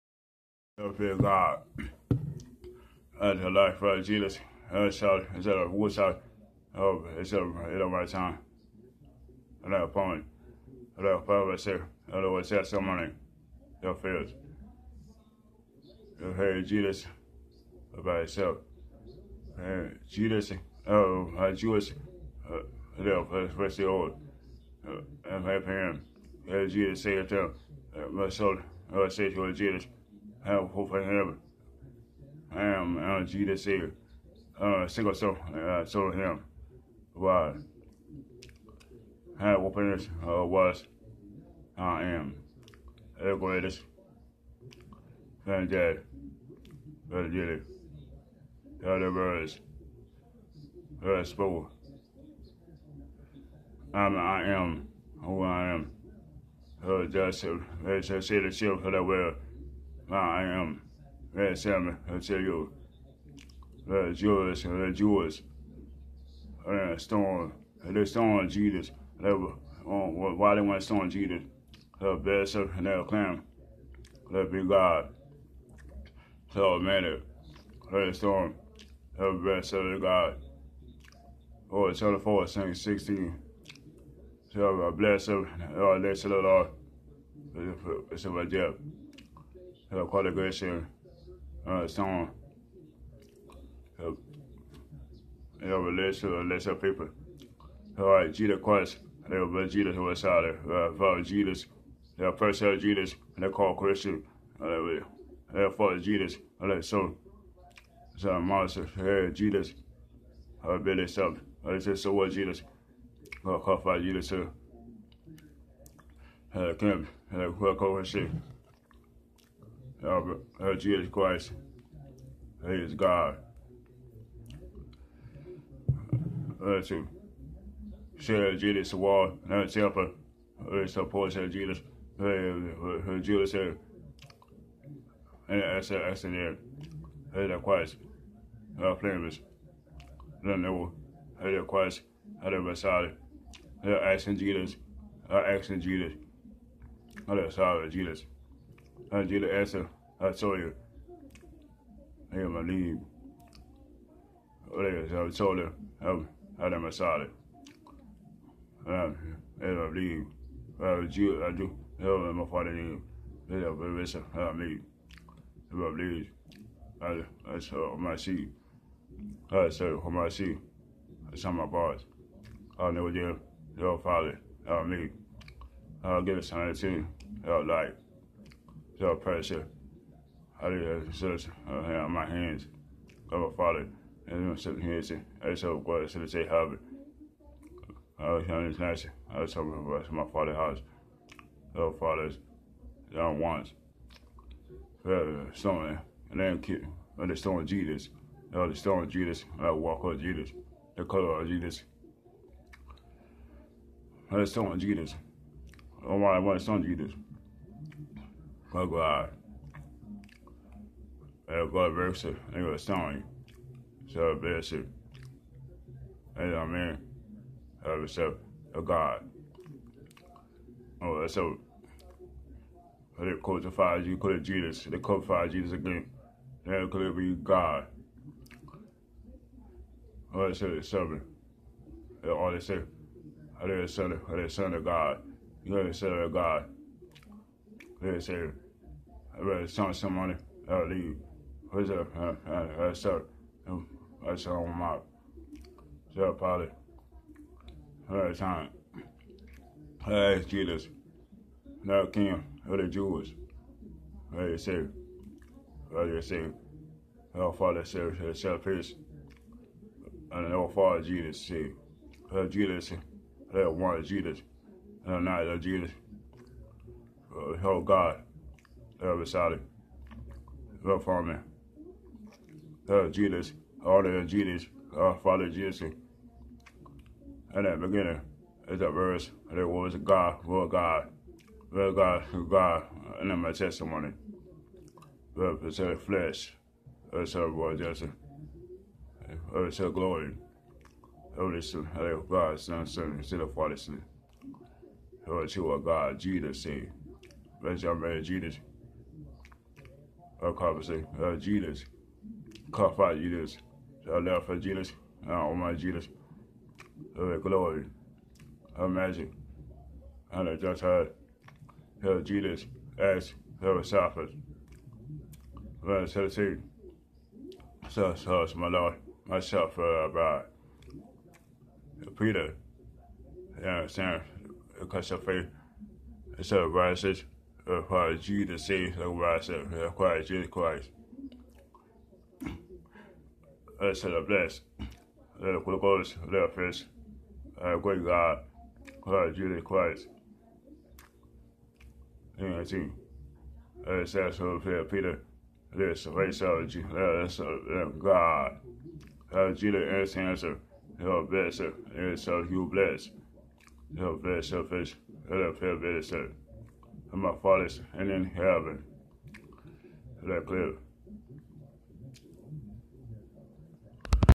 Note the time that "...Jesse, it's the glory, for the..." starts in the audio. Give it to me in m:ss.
4:47.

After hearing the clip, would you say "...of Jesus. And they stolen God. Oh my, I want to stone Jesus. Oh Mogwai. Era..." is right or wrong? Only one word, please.
wrong.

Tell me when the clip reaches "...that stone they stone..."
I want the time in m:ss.
1:06.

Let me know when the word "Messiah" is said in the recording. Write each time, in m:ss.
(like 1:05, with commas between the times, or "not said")
2:22, 2:27.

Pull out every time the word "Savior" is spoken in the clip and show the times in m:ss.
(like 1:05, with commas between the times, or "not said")
0:33, 4:56.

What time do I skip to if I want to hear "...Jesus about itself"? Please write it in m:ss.
0:16.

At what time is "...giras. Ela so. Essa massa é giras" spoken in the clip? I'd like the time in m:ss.
1:46.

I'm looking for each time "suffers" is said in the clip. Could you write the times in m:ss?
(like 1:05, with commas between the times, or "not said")
5:13.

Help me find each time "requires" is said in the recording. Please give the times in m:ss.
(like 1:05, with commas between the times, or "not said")
5:27, 5:38.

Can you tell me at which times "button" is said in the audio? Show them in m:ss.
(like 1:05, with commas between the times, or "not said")
not said.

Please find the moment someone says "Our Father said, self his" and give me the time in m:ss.
4:17.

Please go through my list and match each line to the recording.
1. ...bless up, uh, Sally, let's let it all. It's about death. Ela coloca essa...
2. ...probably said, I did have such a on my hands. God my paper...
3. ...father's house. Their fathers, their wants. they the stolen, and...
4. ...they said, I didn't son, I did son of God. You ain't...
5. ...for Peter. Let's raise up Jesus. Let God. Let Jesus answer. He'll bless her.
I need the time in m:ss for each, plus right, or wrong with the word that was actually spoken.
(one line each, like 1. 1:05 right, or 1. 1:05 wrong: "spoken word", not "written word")
1. 1:24 wrong: "Lord", not "Sally"
2. 3:00 wrong: "father", not "paper"
3. 3:10 right
4. 3:52 right
5. 5:44 right.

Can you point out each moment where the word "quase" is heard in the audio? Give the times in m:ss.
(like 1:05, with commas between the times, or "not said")
1:38.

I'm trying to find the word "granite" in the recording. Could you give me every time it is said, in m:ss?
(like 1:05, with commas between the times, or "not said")
not said.